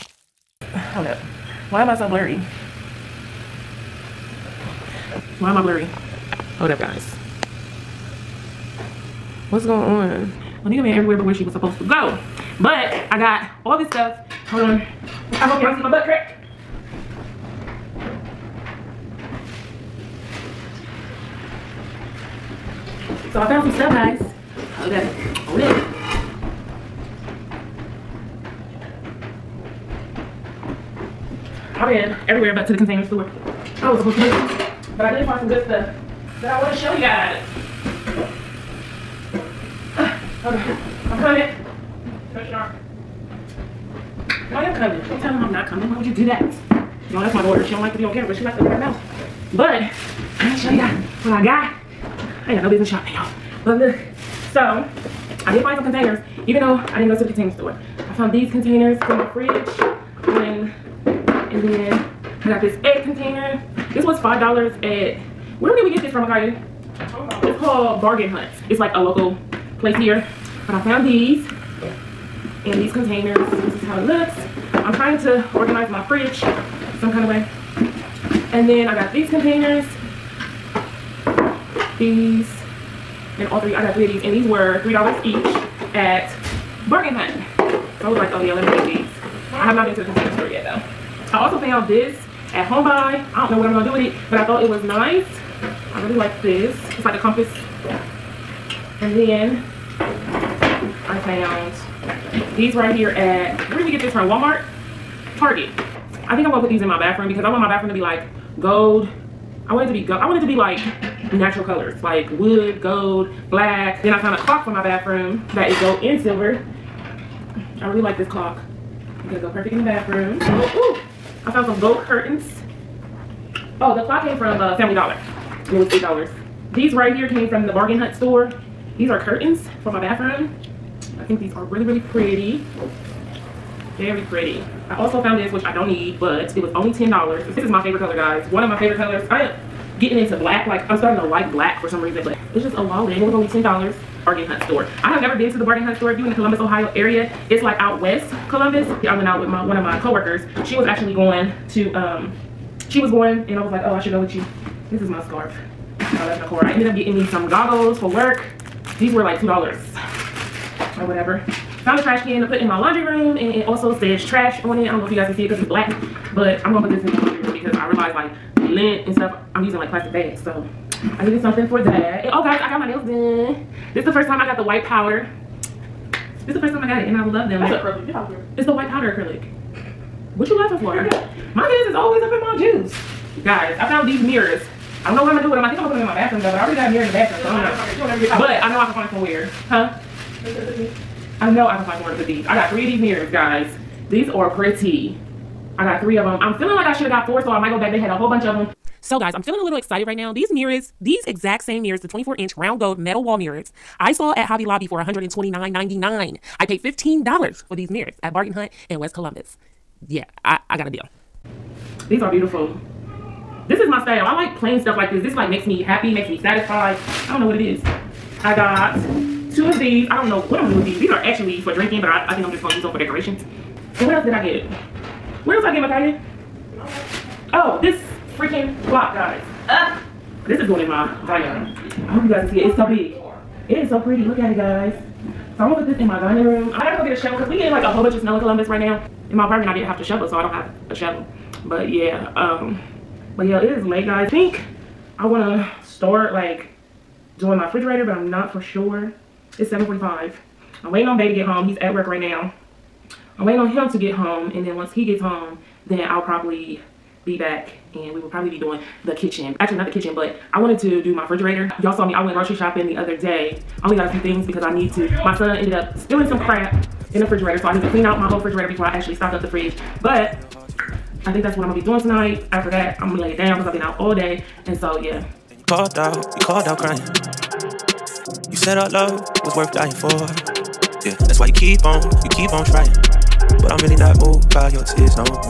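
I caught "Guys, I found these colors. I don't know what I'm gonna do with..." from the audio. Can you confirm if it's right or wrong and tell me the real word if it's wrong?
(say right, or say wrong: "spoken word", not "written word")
wrong: "mirrors", not "colors".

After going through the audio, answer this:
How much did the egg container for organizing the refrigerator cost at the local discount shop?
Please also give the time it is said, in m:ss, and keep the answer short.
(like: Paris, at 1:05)
$5, at 1:04.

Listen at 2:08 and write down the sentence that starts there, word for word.
These are curtains for my bathroom.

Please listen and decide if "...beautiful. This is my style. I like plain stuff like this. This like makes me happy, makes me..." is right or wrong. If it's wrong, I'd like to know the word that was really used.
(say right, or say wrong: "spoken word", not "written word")
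right.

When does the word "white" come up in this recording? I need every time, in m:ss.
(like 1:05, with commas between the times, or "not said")
2:54, 2:58.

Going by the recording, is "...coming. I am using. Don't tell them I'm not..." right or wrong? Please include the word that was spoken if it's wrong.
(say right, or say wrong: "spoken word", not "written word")
wrong: "coming", not "using".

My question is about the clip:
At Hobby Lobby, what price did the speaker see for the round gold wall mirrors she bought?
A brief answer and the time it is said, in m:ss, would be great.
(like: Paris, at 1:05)
$129.99, at 3:24.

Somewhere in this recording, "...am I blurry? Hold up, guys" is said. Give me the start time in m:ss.
0:05.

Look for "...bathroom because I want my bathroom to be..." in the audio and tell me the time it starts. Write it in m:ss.
1:46.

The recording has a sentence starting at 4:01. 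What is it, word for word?
But yeah, um, but yeah, it is late, guys.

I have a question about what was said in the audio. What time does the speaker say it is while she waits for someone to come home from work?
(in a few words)
7:45.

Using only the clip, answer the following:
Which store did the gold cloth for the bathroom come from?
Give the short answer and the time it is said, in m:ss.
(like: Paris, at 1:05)
Family Dollar, at 2:04.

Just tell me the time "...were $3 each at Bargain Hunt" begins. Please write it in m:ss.
1:24.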